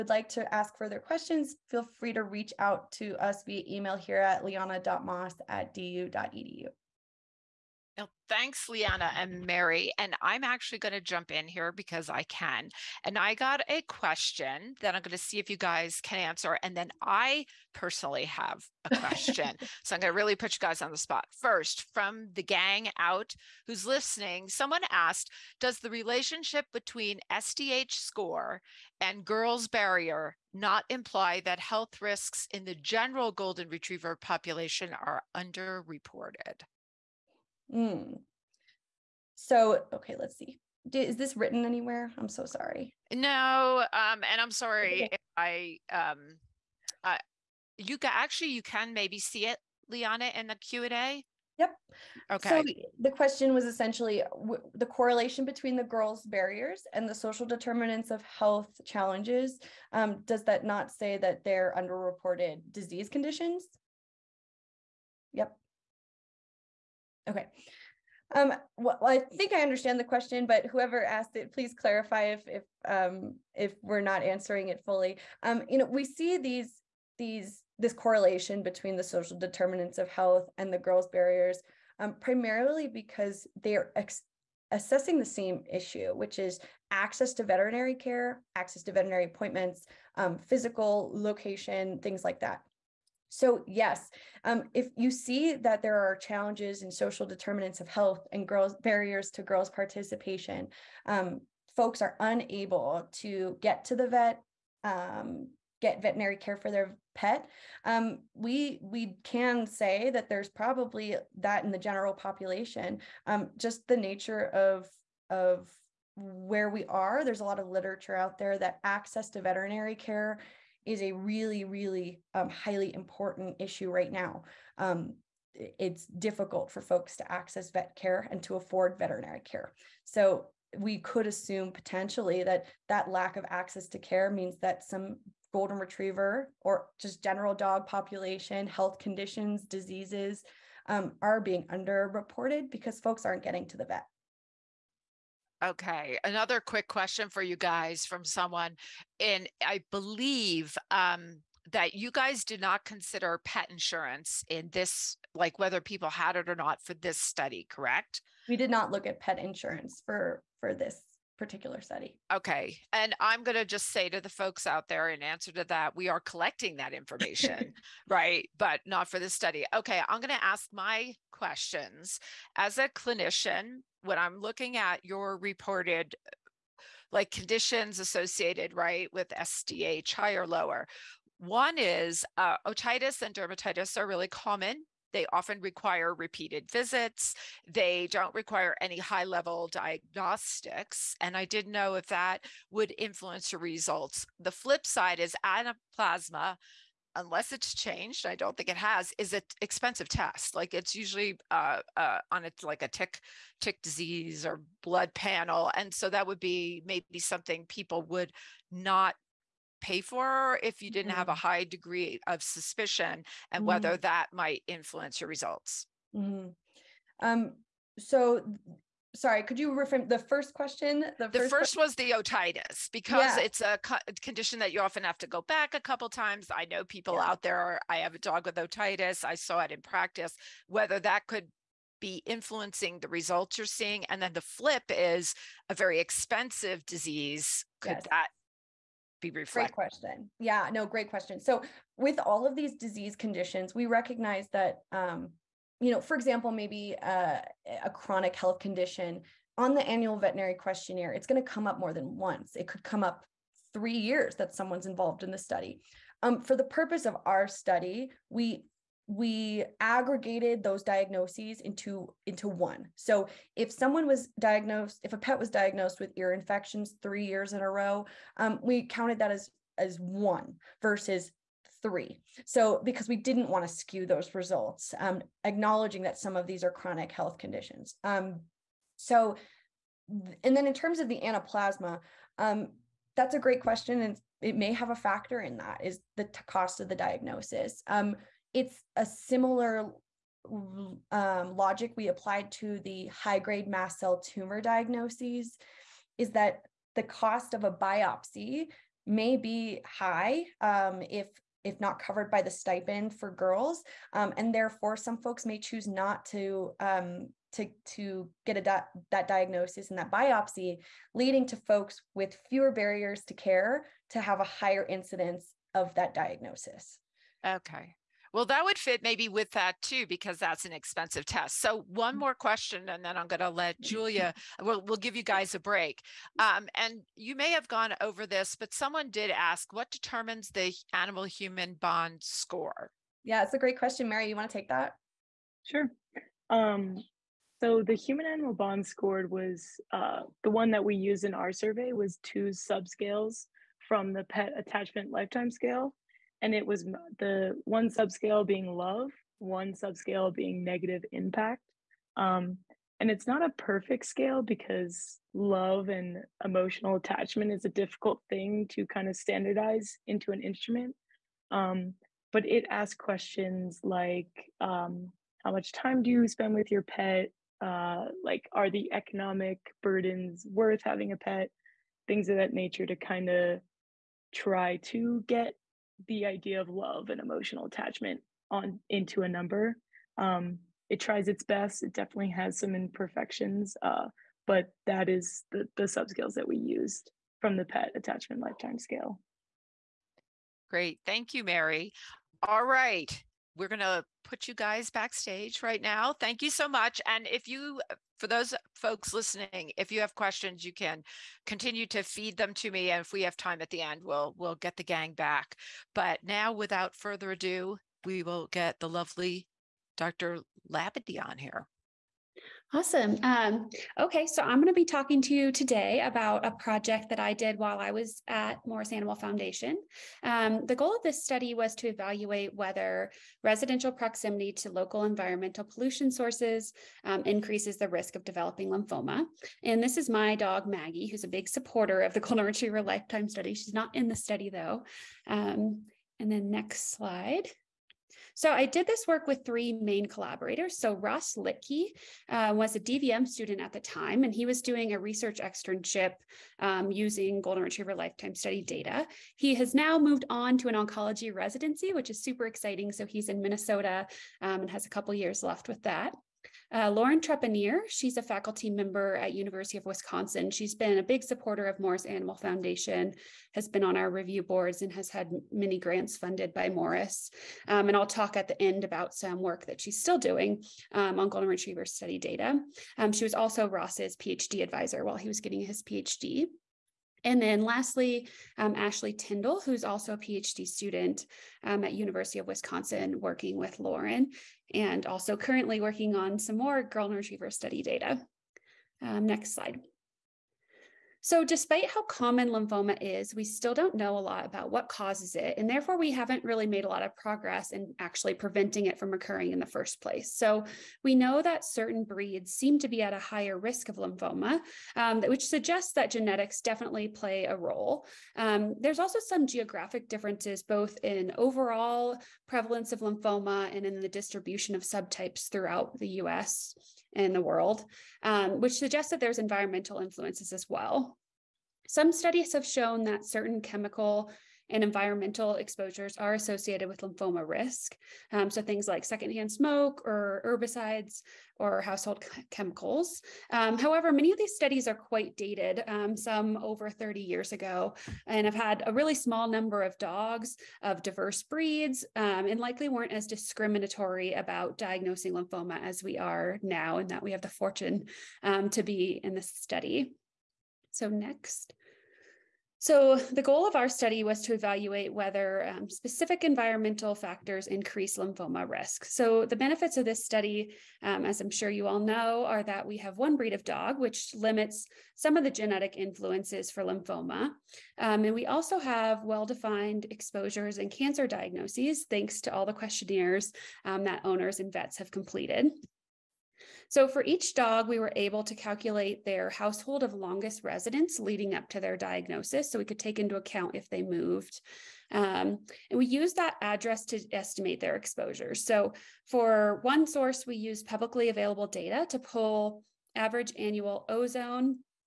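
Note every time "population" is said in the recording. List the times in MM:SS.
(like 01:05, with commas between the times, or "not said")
00:34, 01:52, 02:17.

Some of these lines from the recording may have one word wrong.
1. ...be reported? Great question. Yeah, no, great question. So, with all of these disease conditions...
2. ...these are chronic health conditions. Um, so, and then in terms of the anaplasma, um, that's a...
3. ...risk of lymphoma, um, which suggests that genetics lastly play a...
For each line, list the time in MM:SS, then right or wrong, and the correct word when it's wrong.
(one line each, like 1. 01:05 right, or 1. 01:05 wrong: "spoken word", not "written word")
1. 03:59 wrong: "reflected", not "reported"
2. 04:36 right
3. 08:23 wrong: "definitely", not "lastly".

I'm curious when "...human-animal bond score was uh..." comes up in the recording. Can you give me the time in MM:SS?
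05:37.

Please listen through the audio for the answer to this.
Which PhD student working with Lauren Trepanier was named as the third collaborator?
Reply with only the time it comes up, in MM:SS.
07:58.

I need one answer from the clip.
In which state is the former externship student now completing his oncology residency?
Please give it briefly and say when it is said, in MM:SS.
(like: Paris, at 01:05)
Minnesota, at 07:33.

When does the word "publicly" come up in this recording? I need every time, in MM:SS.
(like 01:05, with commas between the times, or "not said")
09:50.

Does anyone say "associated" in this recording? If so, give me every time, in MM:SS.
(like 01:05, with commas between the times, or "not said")
02:57, 08:46.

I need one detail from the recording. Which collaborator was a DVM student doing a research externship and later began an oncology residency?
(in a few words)
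Ross Litke.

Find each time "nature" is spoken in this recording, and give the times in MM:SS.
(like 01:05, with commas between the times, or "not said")
01:53, 06:12.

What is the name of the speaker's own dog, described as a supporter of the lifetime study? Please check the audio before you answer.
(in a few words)
Maggie.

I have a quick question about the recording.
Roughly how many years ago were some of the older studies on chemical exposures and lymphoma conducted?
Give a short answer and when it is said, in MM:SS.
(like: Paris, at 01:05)
Over 30 years, at 08:56.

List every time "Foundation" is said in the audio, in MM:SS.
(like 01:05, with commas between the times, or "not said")
06:59, 07:42.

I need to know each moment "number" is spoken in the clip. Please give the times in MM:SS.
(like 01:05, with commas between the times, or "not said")
06:19, 08:59.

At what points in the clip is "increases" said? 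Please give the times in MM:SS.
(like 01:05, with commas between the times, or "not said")
07:07, 09:17.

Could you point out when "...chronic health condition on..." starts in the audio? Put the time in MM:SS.
04:07.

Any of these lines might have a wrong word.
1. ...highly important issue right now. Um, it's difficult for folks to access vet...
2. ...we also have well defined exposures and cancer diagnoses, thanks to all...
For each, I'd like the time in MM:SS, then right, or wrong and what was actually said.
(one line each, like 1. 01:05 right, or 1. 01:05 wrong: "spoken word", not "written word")
1. 02:02 right
2. 09:28 right.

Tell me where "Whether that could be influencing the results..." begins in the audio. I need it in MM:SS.
03:50.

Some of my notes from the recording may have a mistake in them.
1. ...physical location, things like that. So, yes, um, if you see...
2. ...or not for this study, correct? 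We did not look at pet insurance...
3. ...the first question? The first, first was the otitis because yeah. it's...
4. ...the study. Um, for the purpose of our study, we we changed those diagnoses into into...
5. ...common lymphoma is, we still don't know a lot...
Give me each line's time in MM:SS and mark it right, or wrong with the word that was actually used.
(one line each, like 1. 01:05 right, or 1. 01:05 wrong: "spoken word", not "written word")
1. 01:30 right
2. 02:36 right
3. 03:40 right
4. 04:15 wrong: "aggregated", not "changed"
5. 08:12 right.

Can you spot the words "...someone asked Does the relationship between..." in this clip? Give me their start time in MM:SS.
00:24.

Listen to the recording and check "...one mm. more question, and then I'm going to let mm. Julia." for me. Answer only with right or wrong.
right.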